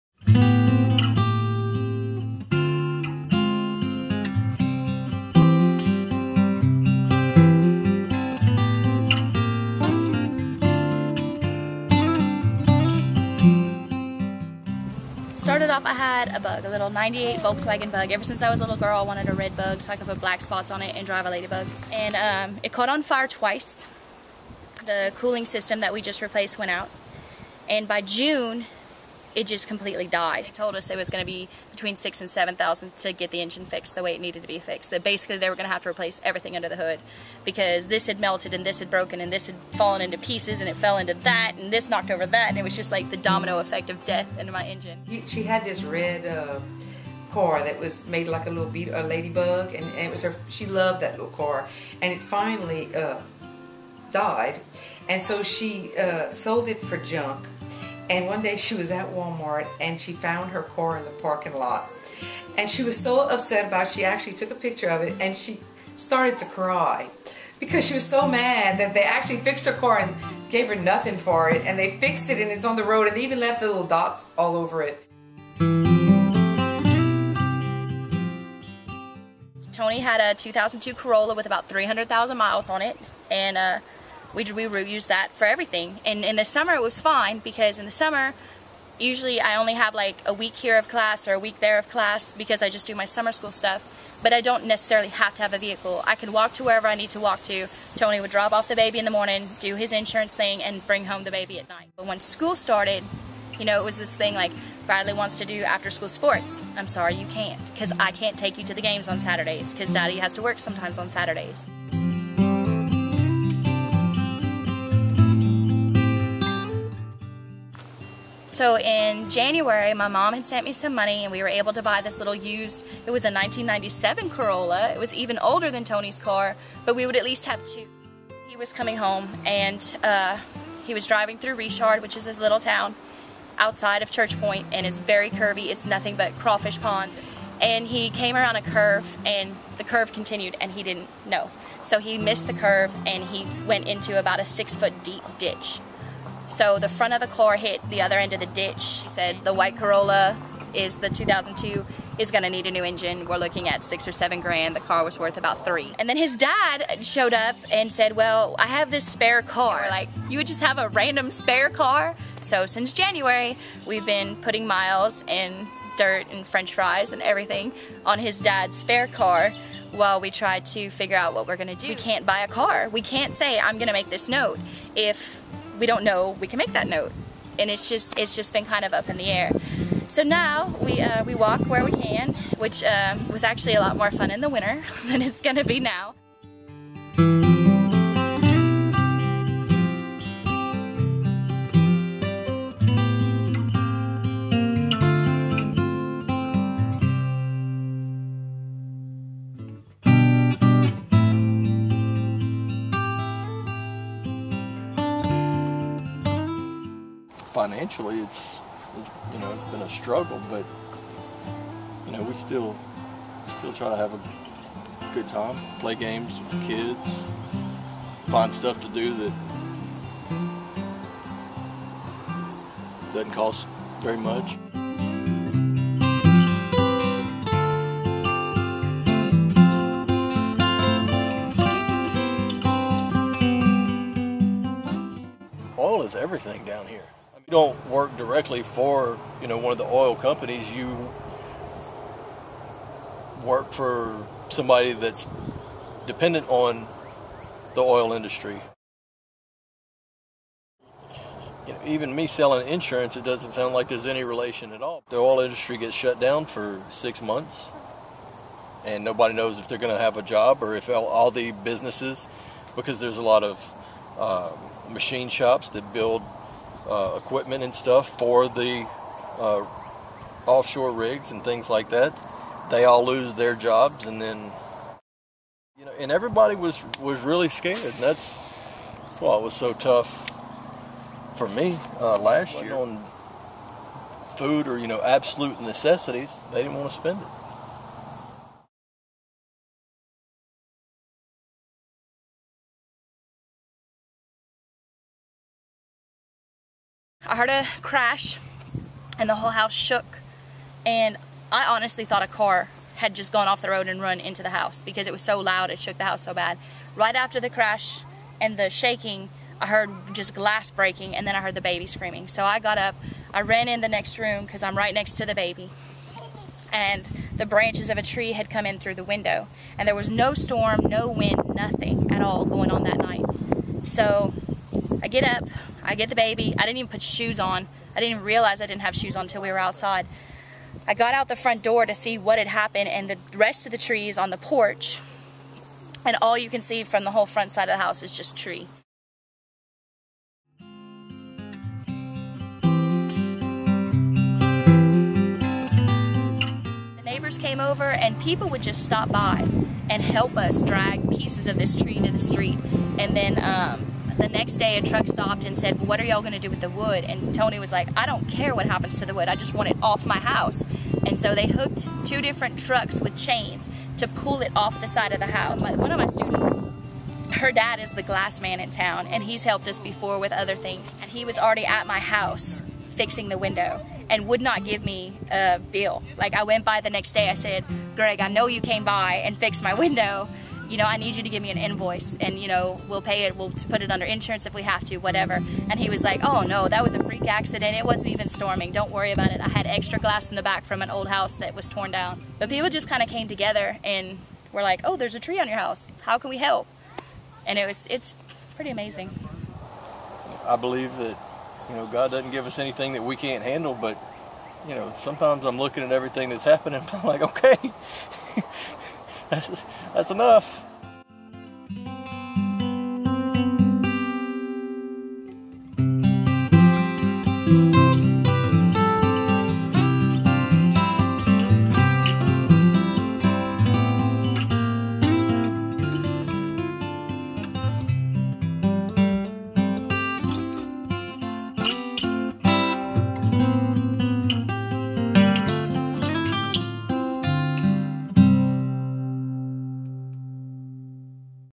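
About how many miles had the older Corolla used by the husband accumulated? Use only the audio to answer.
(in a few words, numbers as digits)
300,000.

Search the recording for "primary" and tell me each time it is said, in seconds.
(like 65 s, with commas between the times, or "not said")
not said.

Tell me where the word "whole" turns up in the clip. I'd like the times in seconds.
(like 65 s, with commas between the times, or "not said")
299 s, 337 s.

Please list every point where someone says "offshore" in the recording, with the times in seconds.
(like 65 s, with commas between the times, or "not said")
270 s.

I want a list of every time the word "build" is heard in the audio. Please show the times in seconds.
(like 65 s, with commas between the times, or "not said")
265 s.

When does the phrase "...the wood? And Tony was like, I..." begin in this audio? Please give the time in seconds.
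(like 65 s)
356 s.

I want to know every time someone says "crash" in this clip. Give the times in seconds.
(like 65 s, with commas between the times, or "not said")
297 s, 307 s.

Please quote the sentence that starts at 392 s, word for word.
But people just kind of came together and were like, oh, there's a tree on your house.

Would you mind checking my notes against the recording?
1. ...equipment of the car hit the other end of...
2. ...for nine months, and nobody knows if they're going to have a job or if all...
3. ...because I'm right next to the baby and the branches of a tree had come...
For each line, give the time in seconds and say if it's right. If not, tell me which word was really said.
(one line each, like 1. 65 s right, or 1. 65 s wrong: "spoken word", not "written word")
1. 146 s wrong: "front", not "equipment"
2. 256 s wrong: "six", not "nine"
3. 314 s right.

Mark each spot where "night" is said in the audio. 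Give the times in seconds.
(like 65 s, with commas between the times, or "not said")
101 s, 322 s.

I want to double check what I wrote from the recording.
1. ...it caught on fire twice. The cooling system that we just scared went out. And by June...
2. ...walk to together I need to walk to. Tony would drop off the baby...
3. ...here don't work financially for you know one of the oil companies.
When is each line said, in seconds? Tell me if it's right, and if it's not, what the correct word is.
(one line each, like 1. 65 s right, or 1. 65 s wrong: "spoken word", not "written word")
1. 22 s wrong: "replaced", not "scared"
2. 96 s wrong: "wherever", not "together"
3. 236 s wrong: "directly", not "financially".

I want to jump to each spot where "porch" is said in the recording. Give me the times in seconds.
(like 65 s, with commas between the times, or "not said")
334 s.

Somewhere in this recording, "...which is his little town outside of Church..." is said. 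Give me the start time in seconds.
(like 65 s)
132 s.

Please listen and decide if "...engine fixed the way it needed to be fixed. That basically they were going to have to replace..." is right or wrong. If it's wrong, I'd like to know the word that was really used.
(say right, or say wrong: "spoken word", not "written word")
right.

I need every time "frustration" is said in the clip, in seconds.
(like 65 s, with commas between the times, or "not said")
not said.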